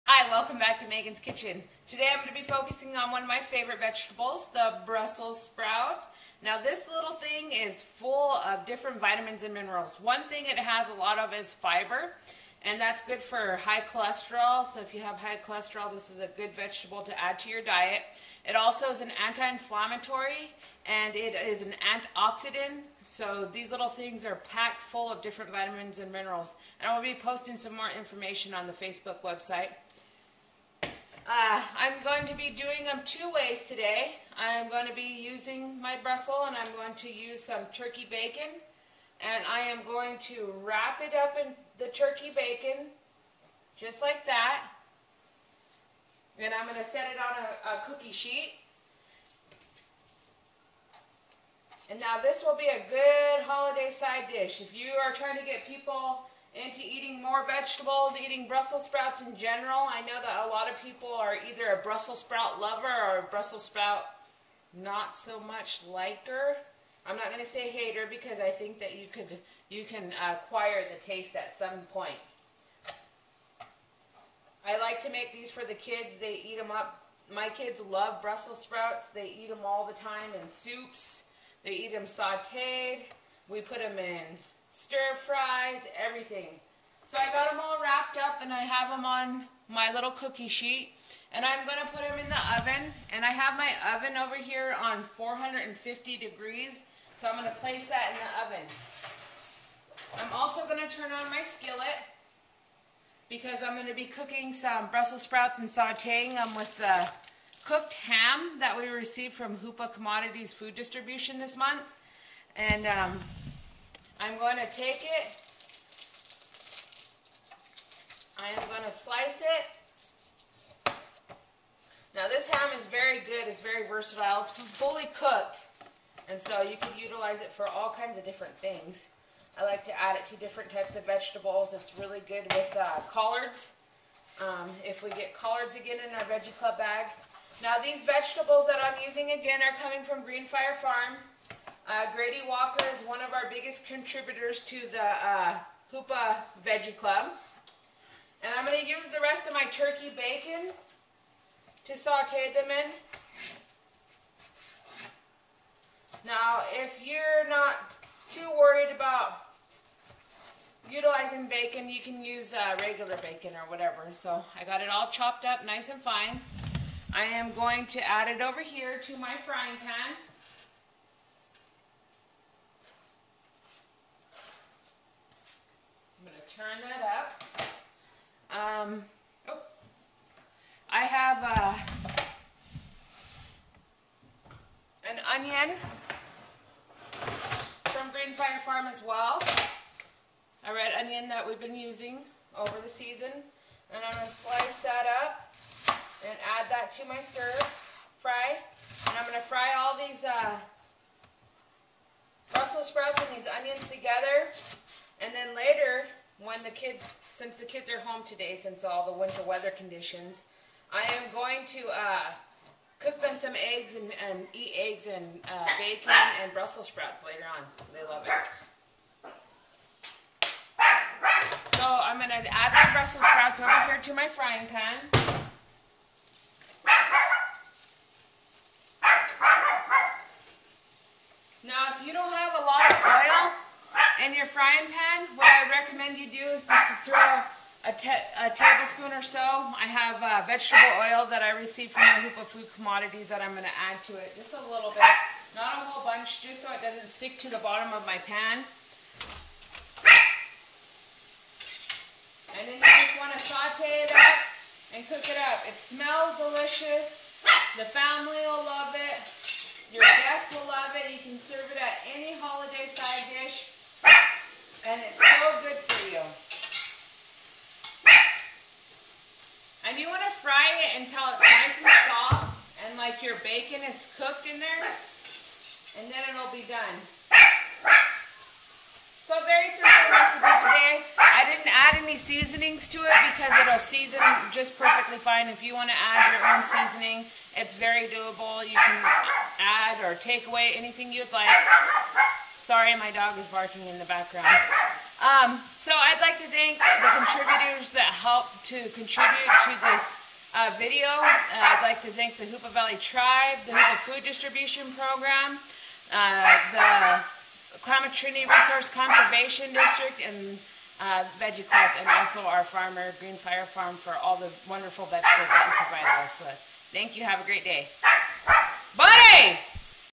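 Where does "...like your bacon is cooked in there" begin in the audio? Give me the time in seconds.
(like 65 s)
272 s.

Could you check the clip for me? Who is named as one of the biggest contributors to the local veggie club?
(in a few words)
Grady Walker.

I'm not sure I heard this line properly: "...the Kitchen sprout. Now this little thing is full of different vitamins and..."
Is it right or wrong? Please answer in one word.
wrong.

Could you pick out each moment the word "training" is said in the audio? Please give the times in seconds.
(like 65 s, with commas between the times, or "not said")
not said.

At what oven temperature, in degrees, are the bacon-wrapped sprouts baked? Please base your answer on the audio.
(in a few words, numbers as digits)
450.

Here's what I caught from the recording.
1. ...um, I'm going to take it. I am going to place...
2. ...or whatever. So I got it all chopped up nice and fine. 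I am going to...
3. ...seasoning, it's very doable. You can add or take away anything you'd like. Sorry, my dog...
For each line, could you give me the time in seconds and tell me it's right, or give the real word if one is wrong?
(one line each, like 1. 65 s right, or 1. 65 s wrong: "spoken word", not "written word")
1. 112 s wrong: "slice", not "place"
2. 163 s right
3. 286 s right.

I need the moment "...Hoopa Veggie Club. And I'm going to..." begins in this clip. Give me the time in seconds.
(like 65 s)
145 s.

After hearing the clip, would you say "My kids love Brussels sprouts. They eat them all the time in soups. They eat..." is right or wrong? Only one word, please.
right.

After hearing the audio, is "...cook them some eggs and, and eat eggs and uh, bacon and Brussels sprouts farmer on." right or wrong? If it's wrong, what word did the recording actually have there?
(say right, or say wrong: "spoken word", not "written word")
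wrong: "later", not "farmer".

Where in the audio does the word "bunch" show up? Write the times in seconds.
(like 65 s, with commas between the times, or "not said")
246 s.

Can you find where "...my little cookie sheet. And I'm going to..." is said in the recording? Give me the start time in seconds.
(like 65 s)
89 s.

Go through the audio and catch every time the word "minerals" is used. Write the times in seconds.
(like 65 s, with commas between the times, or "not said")
9 s, 26 s.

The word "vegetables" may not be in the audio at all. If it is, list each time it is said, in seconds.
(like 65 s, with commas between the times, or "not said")
3 s, 16 s, 57 s, 131 s, 138 s, 240 s, 315 s.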